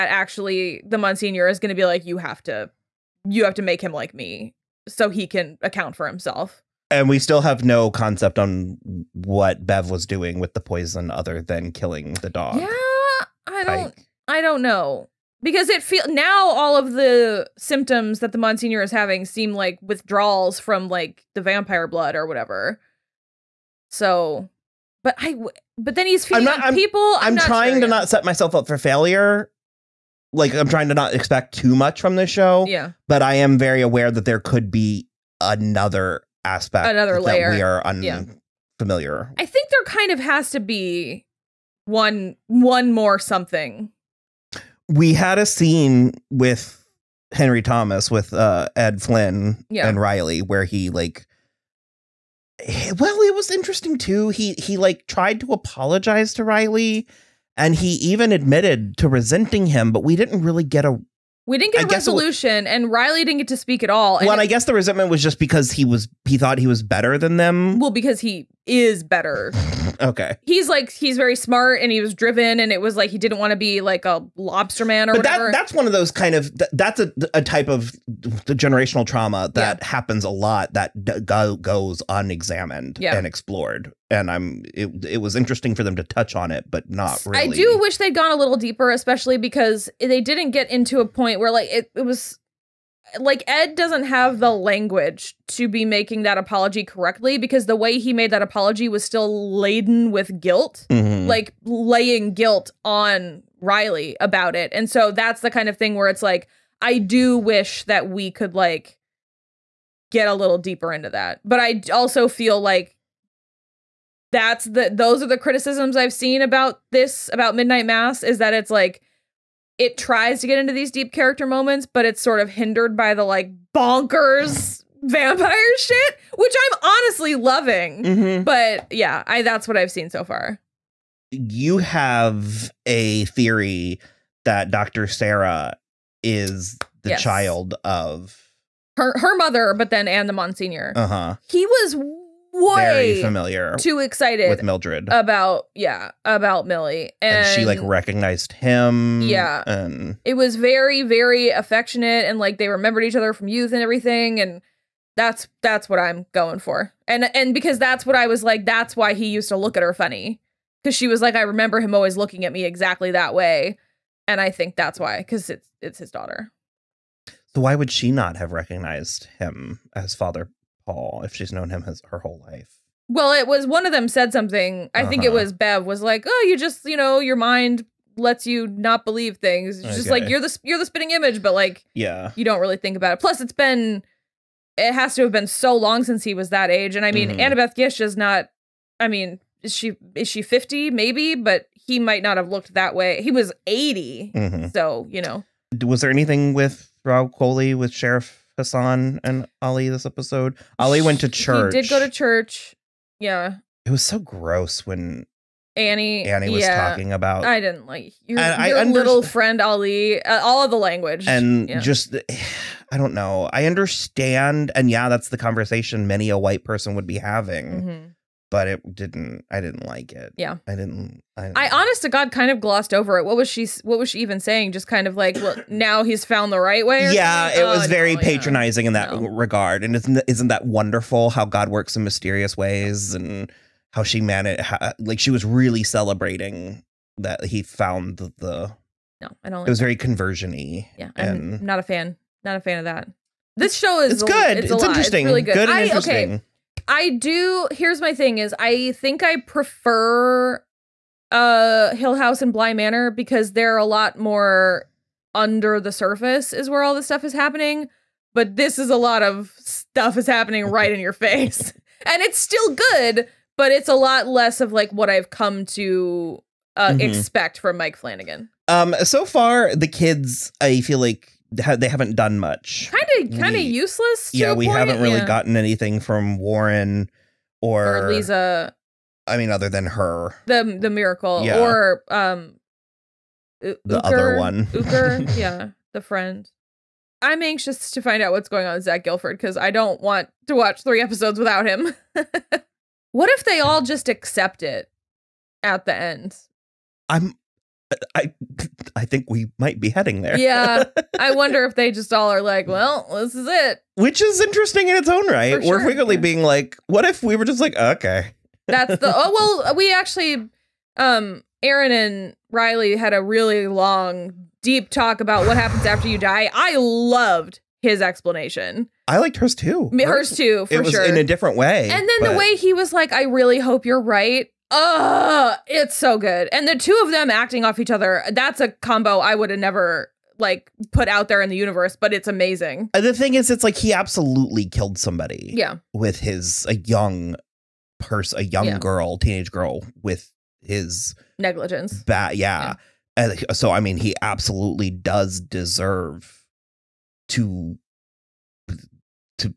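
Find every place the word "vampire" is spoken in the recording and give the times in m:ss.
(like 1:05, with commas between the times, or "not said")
0:21, 2:05.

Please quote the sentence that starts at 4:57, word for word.
I'm I I think we might be heading there.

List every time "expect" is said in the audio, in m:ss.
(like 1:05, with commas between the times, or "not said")
0:31, 4:27.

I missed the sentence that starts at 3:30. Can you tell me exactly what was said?
Uh, all of the language and yeah.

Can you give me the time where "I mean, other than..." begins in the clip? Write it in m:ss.
4:39.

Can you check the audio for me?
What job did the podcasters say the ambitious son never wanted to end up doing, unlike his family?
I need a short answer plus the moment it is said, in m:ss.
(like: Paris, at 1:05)
lobster man, at 1:14.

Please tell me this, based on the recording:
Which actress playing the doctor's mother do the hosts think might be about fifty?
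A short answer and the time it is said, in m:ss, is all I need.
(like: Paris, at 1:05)
Annabeth Gish, at 3:07.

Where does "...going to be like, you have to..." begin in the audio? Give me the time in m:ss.
0:01.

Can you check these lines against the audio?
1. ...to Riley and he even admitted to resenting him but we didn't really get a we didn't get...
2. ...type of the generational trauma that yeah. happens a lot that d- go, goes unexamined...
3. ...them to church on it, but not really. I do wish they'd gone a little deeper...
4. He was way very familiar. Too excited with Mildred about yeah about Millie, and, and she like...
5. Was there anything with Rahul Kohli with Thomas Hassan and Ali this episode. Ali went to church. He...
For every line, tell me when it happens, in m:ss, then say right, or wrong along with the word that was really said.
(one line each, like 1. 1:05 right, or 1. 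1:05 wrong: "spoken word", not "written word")
1. 0:56 right
2. 1:17 right
3. 1:25 wrong: "touch", not "church"
4. 2:21 right
5. 3:15 wrong: "Sheriff", not "Thomas".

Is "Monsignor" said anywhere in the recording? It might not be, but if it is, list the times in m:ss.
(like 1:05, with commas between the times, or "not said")
0:00, 0:18, 2:20.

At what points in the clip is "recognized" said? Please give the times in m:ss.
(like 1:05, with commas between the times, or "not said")
2:27, 2:48.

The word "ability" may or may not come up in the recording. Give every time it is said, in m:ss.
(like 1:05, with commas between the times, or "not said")
not said.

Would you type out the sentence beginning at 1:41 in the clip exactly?
like laying guilt on Riley about it.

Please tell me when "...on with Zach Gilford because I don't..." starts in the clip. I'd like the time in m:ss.
4:48.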